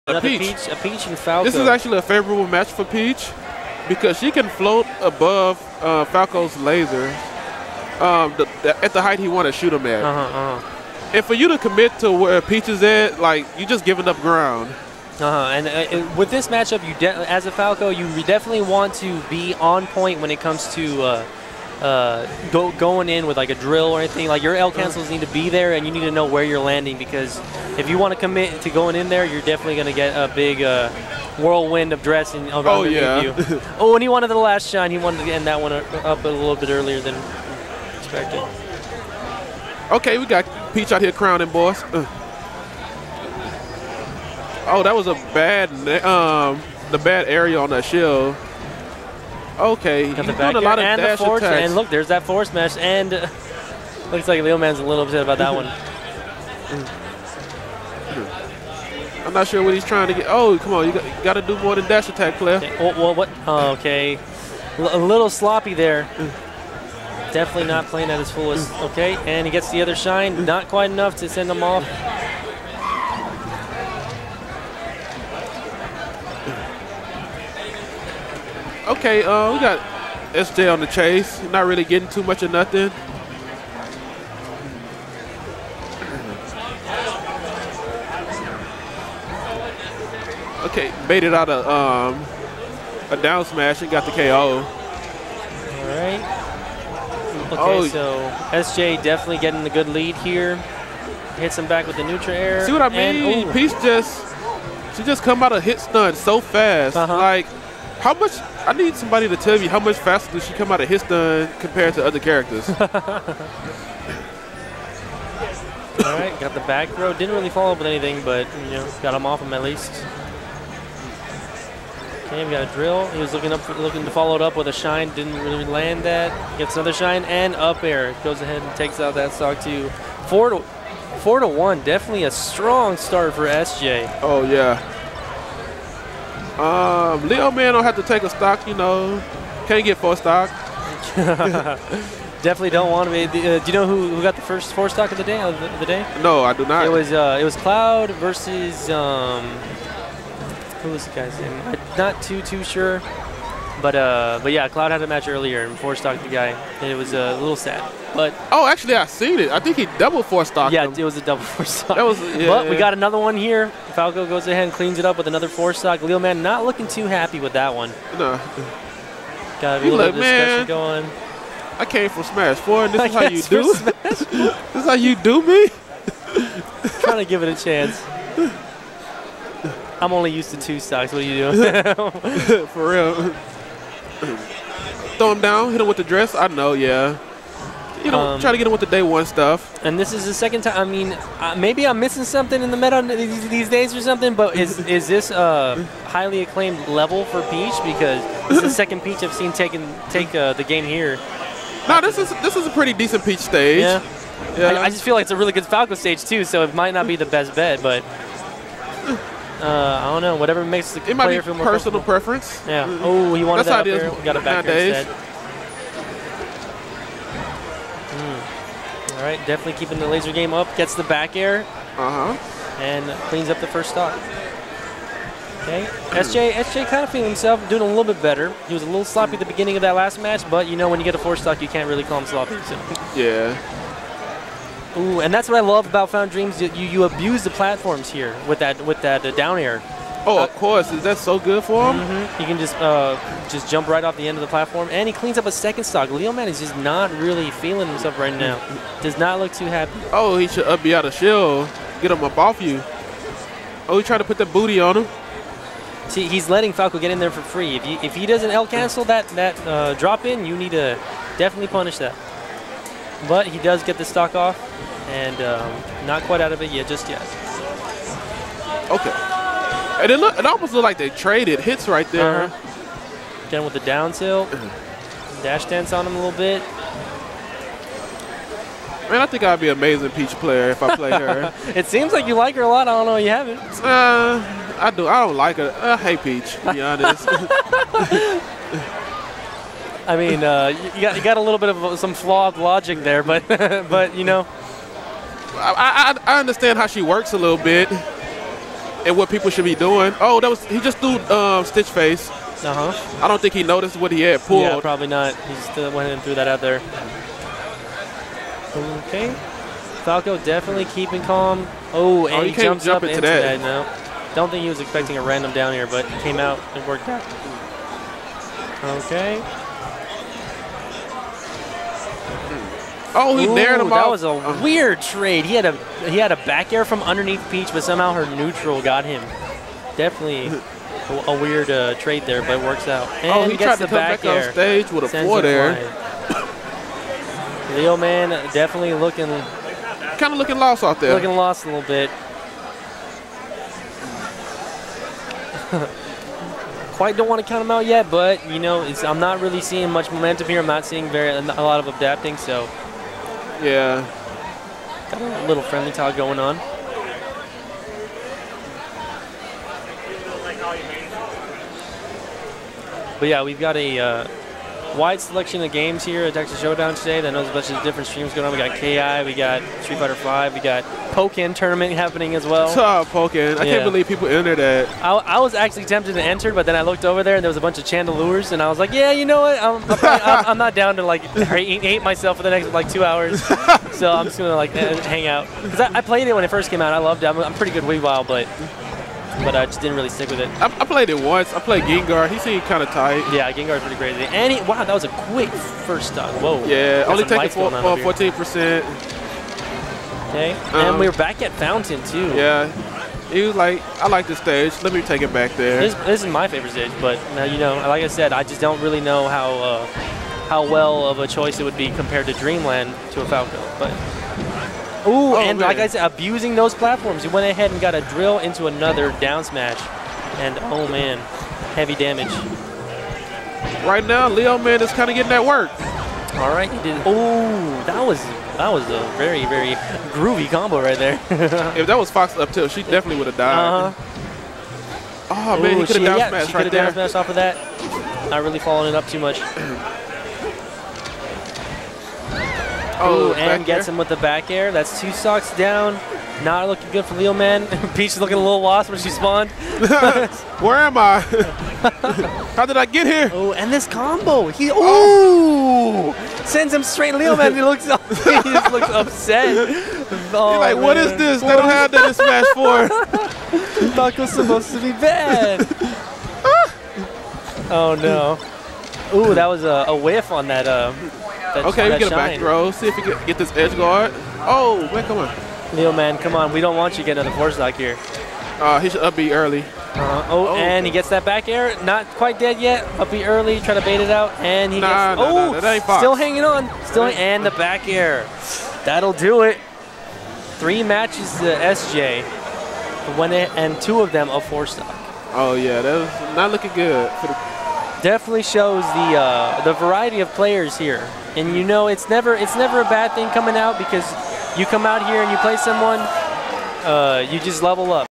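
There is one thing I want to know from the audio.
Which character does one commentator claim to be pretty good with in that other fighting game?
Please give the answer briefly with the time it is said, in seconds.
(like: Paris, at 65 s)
Weavile, at 387 s.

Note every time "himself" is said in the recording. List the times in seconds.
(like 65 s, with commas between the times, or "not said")
227 s, 247 s.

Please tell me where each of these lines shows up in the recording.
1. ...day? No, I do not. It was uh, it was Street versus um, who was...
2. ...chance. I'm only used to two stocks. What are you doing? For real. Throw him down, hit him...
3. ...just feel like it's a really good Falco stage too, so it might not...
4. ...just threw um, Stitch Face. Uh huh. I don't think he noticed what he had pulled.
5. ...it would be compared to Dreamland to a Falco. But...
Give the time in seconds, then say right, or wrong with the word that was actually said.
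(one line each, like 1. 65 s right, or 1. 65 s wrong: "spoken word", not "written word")
1. 145 s wrong: "Cloud", not "Street"
2. 177 s right
3. 204 s right
4. 300 s right
5. 411 s right.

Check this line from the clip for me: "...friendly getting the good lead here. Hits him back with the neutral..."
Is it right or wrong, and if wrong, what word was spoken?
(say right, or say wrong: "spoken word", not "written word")
wrong: "definitely", not "friendly".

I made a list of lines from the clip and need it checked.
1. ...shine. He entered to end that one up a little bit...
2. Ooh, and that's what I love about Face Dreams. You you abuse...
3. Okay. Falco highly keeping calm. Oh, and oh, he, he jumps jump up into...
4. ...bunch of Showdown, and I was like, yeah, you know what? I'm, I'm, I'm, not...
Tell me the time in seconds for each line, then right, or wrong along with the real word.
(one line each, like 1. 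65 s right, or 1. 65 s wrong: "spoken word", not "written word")
1. 34 s wrong: "wanted", not "entered"
2. 234 s wrong: "Found", not "Face"
3. 309 s wrong: "definitely", not "highly"
4. 377 s wrong: "Chandelures", not "Showdown".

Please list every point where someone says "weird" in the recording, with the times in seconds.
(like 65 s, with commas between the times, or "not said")
324 s, 331 s.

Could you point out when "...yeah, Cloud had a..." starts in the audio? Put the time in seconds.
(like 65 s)
154 s.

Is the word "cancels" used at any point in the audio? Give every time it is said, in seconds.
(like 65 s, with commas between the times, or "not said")
24 s, 258 s.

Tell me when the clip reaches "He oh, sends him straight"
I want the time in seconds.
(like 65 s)
454 s.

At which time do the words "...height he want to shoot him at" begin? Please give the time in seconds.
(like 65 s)
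9 s.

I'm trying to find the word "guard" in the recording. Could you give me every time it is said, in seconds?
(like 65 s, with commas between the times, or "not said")
473 s.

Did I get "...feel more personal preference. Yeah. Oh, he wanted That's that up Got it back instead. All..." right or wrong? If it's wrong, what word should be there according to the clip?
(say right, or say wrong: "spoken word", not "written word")
right.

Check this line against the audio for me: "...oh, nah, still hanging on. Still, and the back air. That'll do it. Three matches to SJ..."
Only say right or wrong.
right.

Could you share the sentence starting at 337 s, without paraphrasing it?
Leo man definitely looking kind of looking lost out there.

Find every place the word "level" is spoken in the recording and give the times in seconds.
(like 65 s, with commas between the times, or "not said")
196 s, 507 s.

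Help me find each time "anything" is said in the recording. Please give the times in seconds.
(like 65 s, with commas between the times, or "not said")
23 s, 117 s.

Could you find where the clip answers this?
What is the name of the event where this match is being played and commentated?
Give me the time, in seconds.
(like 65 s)
366 s.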